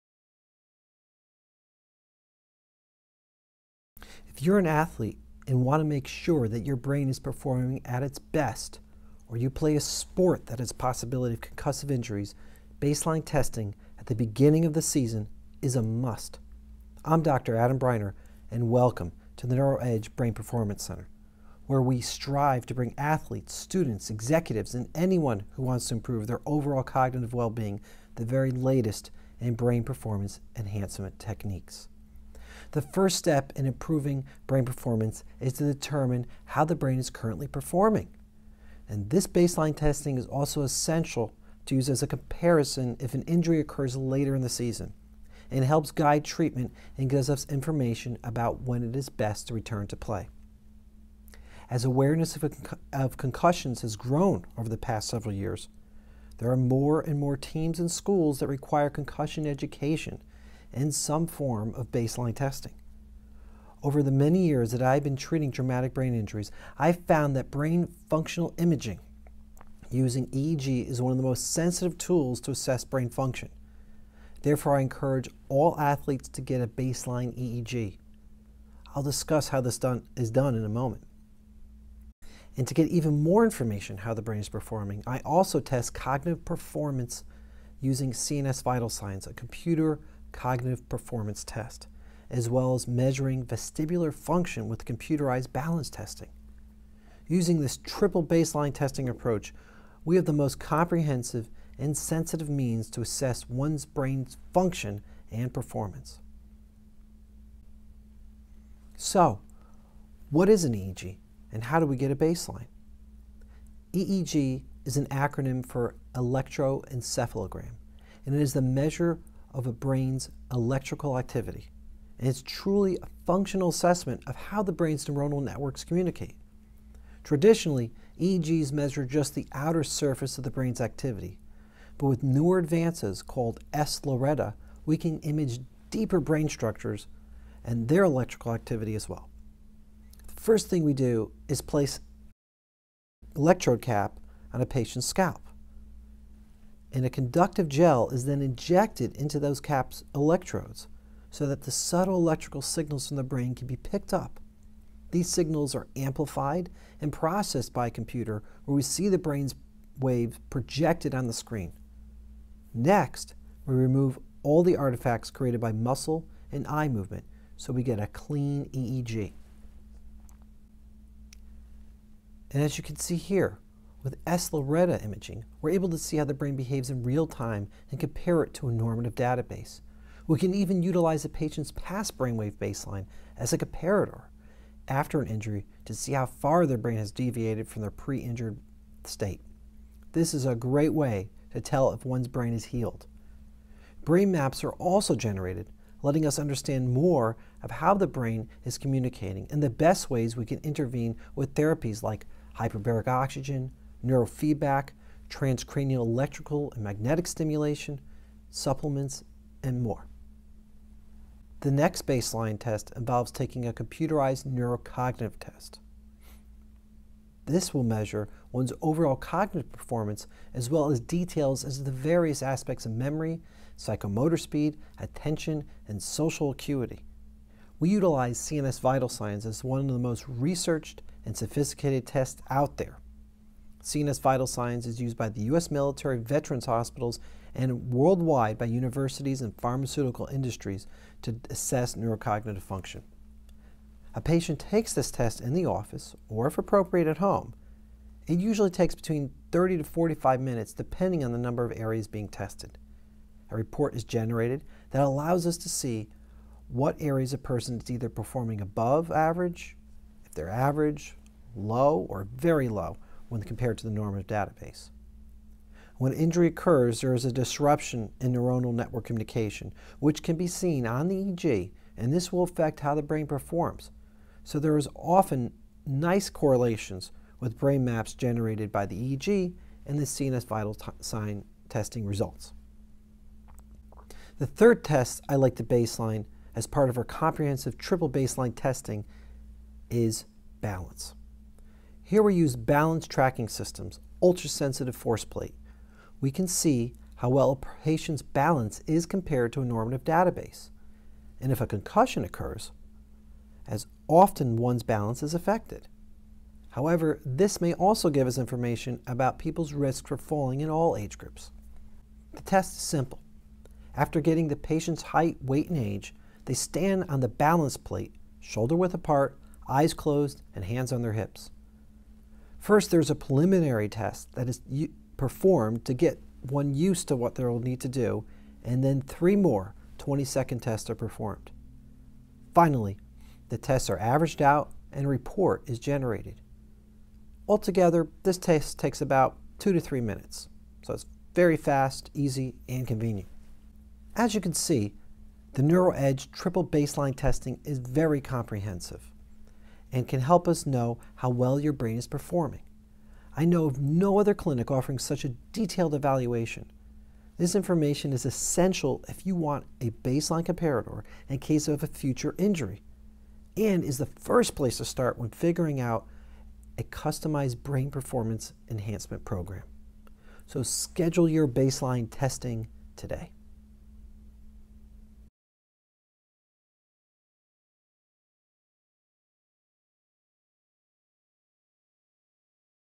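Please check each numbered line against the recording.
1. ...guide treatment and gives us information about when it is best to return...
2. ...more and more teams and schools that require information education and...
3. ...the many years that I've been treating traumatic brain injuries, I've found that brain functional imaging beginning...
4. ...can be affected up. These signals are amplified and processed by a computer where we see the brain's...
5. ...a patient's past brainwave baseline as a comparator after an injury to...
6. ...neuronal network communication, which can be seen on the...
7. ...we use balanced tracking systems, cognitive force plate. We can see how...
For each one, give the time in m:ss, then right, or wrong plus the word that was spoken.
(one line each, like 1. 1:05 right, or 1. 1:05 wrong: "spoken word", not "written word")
1. 0:45 right
2. 0:56 wrong: "concussion", not "information"
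3. 1:04 wrong: "using", not "beginning"
4. 2:33 wrong: "picked", not "affected"
5. 3:01 right
6. 4:28 right
7. 4:52 wrong: "ultrasensitive", not "cognitive".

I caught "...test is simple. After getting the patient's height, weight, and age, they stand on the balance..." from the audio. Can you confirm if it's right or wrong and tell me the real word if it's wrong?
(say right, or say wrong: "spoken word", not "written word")
right.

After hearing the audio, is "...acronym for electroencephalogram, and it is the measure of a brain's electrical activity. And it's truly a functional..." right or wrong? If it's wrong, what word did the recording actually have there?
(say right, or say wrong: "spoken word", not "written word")
right.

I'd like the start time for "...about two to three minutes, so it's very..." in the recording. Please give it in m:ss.
5:39.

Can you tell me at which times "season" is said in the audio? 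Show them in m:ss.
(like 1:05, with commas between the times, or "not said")
0:14, 0:44.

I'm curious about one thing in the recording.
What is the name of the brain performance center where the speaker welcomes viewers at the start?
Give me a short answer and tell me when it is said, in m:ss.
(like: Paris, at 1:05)
NeuroEdge Brain Performance Center, at 0:19.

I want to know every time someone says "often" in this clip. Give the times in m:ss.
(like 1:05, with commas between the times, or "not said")
4:34, 5:04.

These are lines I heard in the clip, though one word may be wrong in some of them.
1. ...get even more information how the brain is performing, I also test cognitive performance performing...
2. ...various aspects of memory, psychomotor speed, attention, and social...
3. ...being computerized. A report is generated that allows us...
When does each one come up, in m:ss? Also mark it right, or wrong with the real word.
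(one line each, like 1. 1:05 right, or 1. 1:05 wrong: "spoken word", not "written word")
1. 1:22 wrong: "using", not "performing"
2. 3:41 right
3. 4:12 wrong: "tested", not "computerized".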